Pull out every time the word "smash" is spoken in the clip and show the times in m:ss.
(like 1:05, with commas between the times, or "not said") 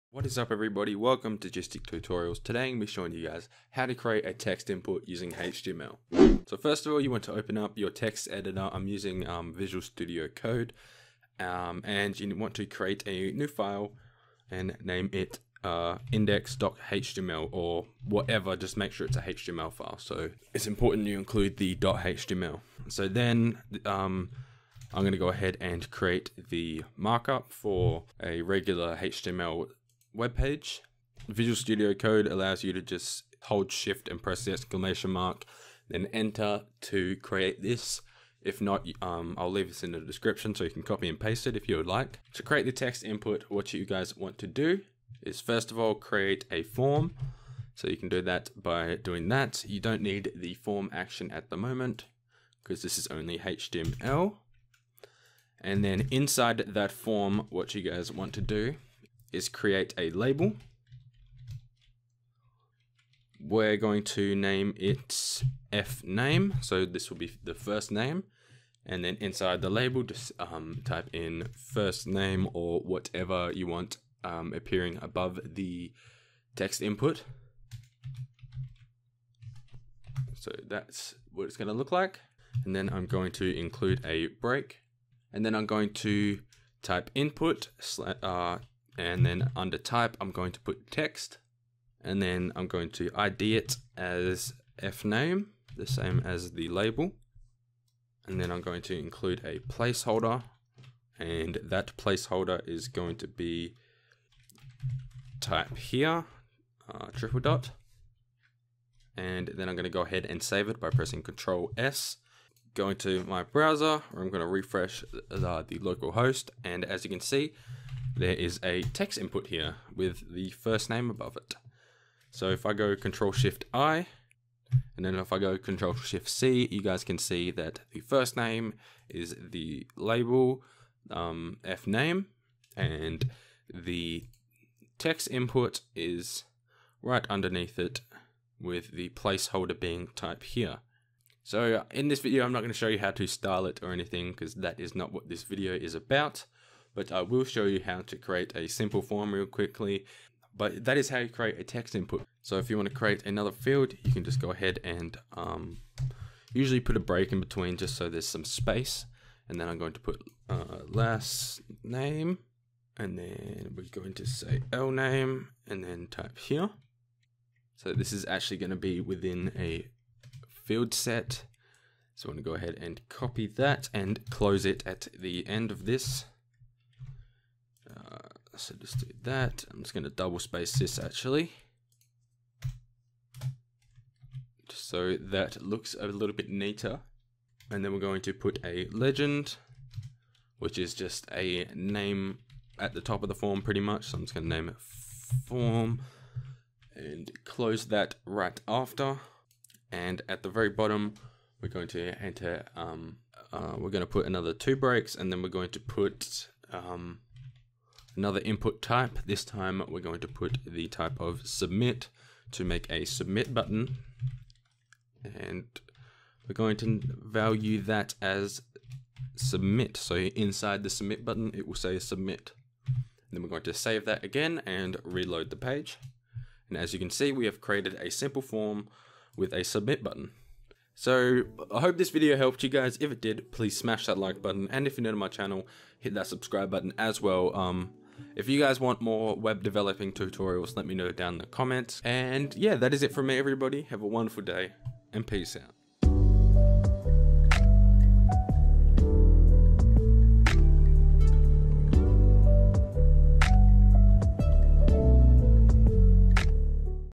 3:53.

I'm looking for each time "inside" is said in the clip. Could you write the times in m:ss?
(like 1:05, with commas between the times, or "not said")
0:56, 1:09, 3:40.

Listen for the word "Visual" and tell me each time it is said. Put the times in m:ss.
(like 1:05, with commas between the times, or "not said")
0:09, 0:31.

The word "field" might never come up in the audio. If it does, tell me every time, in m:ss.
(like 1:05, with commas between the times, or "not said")
2:33, 2:50.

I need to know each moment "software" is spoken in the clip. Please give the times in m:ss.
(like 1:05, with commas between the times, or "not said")
not said.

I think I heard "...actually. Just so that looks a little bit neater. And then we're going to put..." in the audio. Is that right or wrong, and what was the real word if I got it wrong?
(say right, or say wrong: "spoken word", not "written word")
right.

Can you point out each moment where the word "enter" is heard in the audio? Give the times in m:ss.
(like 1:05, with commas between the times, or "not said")
0:36, 3:22.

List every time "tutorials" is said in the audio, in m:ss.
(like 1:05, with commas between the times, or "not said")
0:01, 4:00.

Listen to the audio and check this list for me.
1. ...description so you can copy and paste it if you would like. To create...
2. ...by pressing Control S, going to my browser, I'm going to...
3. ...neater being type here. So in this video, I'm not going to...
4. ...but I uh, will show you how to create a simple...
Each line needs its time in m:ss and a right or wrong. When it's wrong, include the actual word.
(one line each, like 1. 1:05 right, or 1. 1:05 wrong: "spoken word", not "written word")
1. 0:39 right
2. 1:50 right
3. 2:19 wrong: "placeholder", not "neater"
4. 2:26 right.